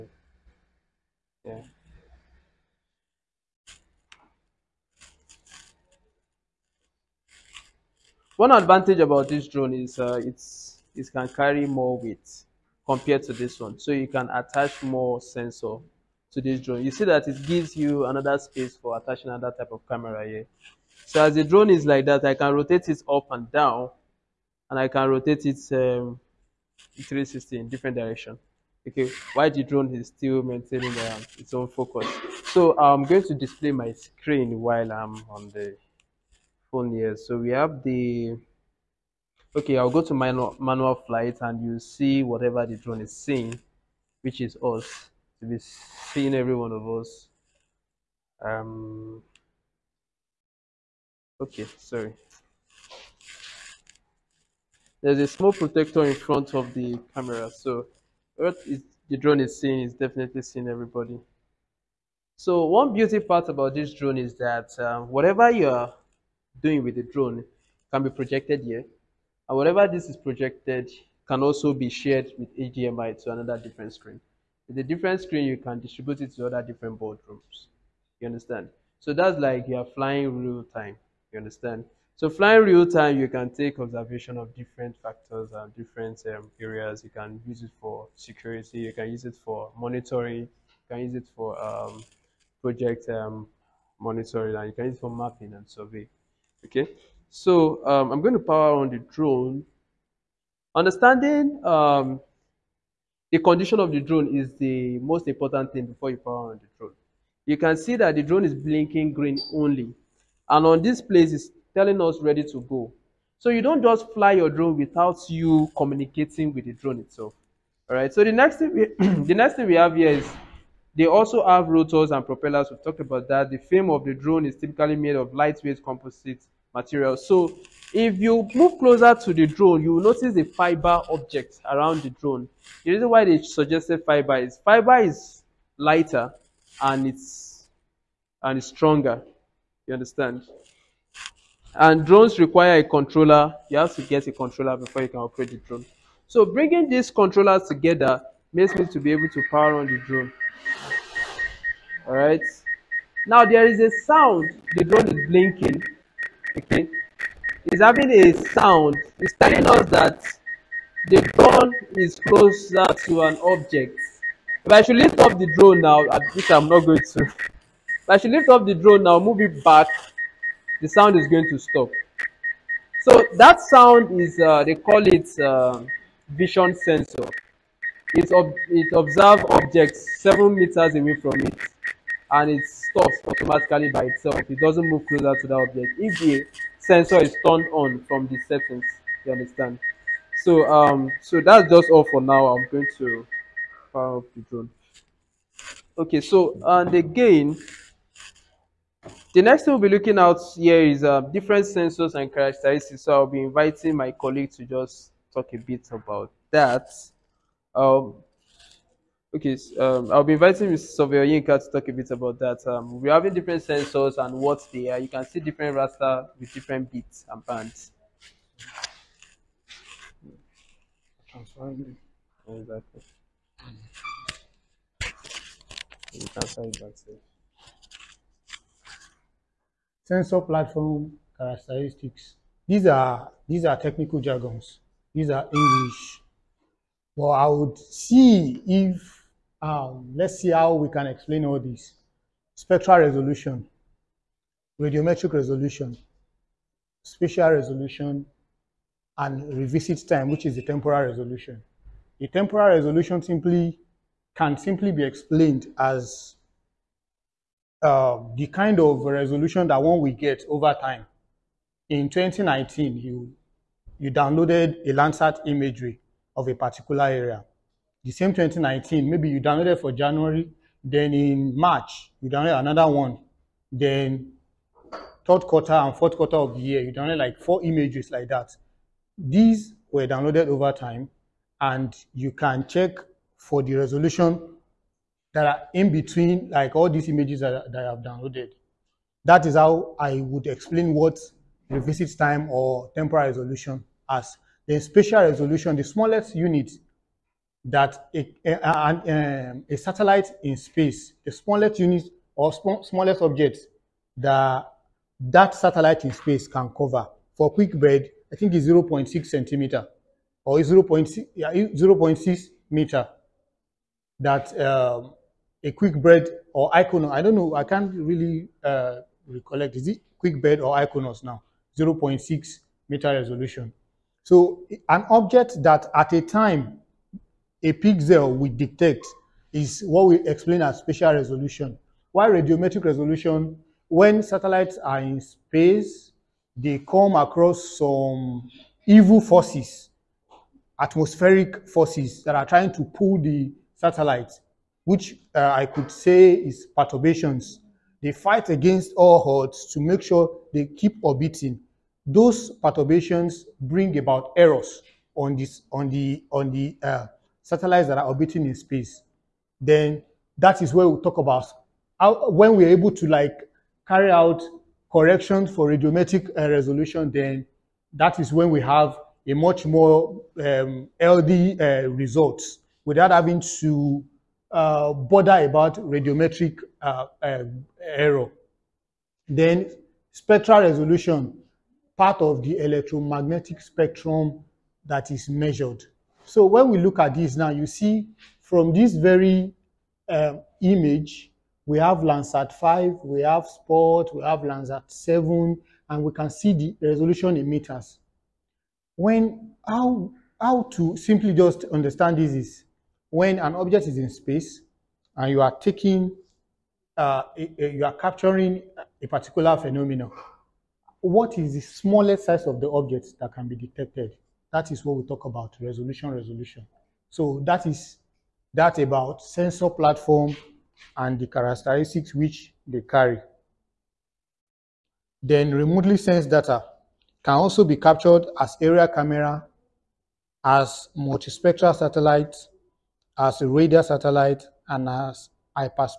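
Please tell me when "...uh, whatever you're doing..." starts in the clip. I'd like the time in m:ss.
1:04.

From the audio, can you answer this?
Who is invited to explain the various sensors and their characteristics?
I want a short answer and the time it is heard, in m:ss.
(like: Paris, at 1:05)
Mr. Sovio Yinka, at 3:30.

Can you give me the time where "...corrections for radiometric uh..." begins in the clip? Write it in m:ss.
6:04.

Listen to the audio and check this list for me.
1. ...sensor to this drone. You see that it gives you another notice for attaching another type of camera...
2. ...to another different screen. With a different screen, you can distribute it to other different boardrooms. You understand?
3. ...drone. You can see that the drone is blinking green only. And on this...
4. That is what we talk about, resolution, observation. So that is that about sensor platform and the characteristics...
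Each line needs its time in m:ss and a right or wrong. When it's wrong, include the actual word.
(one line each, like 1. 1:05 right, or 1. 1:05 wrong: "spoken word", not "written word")
1. 0:15 wrong: "space", not "notice"
2. 1:13 right
3. 1:46 right
4. 6:54 wrong: "resolution", not "observation".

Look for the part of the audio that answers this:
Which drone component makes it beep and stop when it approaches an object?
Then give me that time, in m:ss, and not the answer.
2:56.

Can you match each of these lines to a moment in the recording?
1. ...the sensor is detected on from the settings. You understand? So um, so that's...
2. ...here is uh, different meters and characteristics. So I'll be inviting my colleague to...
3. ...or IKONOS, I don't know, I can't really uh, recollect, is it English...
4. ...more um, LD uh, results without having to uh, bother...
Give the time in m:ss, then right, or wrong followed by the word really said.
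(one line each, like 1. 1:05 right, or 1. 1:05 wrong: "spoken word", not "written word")
1. 3:06 wrong: "turned", not "detected"
2. 3:20 wrong: "sensors", not "meters"
3. 5:16 wrong: "QuickBird", not "English"
4. 6:09 right.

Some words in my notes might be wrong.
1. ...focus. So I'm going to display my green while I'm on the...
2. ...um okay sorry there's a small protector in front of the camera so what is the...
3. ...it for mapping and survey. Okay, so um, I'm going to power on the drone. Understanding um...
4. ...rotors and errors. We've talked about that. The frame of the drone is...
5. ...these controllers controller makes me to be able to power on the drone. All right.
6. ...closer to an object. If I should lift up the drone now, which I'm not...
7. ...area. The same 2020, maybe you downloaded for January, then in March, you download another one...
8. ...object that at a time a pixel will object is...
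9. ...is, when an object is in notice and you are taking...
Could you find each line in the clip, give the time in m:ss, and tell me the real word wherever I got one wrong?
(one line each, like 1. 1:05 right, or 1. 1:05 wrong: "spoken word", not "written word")
1. 0:31 wrong: "screen", not "green"
2. 0:48 right
3. 1:34 right
4. 2:01 wrong: "propellers", not "errors"
5. 2:26 wrong: "together", not "controller"
6. 2:42 right
7. 4:27 wrong: "2019", not "2020"
8. 5:25 wrong: "detect", not "object"
9. 6:42 wrong: "space", not "notice".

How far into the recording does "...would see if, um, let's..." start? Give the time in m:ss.
3:57.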